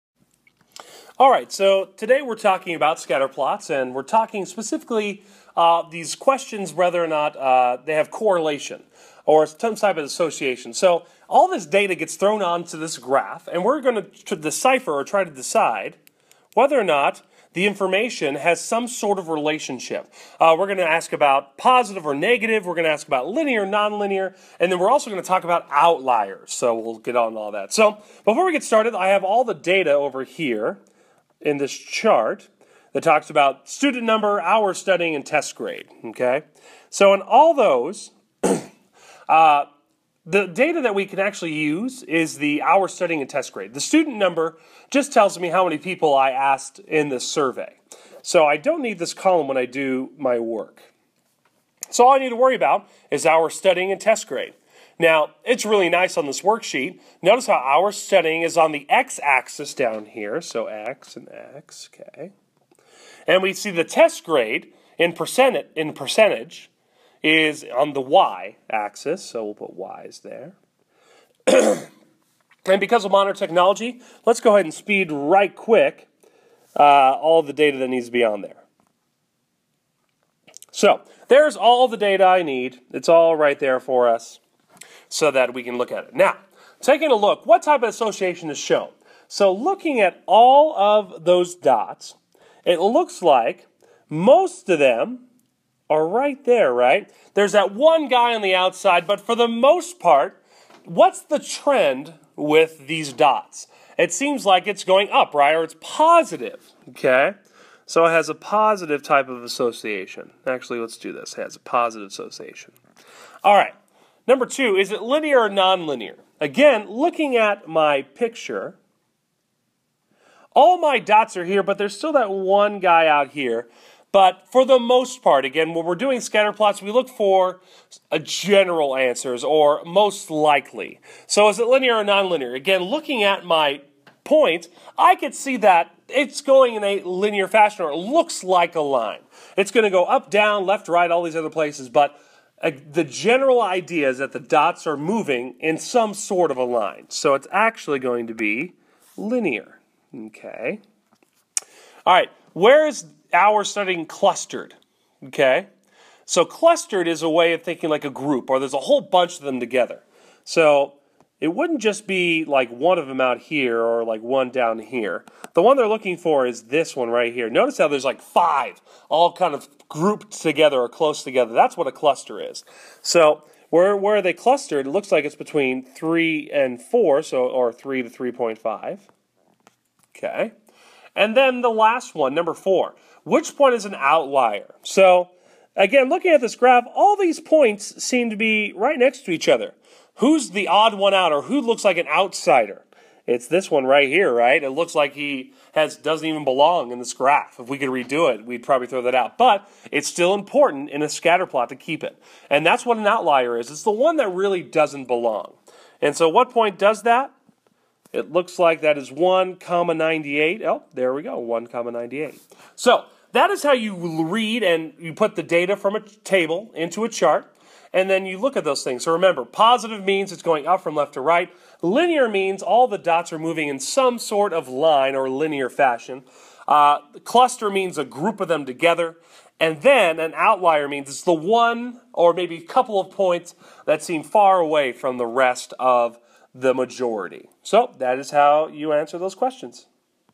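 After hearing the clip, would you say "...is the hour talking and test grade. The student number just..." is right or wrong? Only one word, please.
wrong.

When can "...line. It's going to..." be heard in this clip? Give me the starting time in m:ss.
2:18.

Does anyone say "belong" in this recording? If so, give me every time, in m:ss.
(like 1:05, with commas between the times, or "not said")
3:16, 3:25.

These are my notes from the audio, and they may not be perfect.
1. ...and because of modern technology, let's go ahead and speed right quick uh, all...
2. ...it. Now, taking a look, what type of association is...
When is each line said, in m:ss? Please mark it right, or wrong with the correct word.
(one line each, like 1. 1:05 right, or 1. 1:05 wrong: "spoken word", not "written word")
1. 1:11 right
2. 1:26 right.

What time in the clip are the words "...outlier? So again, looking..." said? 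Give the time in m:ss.
3:03.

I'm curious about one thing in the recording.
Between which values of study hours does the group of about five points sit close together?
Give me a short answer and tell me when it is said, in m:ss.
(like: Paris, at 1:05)
3 and 4, at 2:55.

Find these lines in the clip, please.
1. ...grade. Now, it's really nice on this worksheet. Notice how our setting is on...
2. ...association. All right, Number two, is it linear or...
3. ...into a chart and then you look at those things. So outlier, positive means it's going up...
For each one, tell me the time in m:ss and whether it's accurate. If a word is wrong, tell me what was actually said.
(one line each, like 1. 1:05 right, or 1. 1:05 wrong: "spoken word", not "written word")
1. 0:54 right
2. 1:52 right
3. 3:36 wrong: "remember", not "outlier".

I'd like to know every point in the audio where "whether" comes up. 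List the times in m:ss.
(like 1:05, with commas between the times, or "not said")
0:06, 0:16.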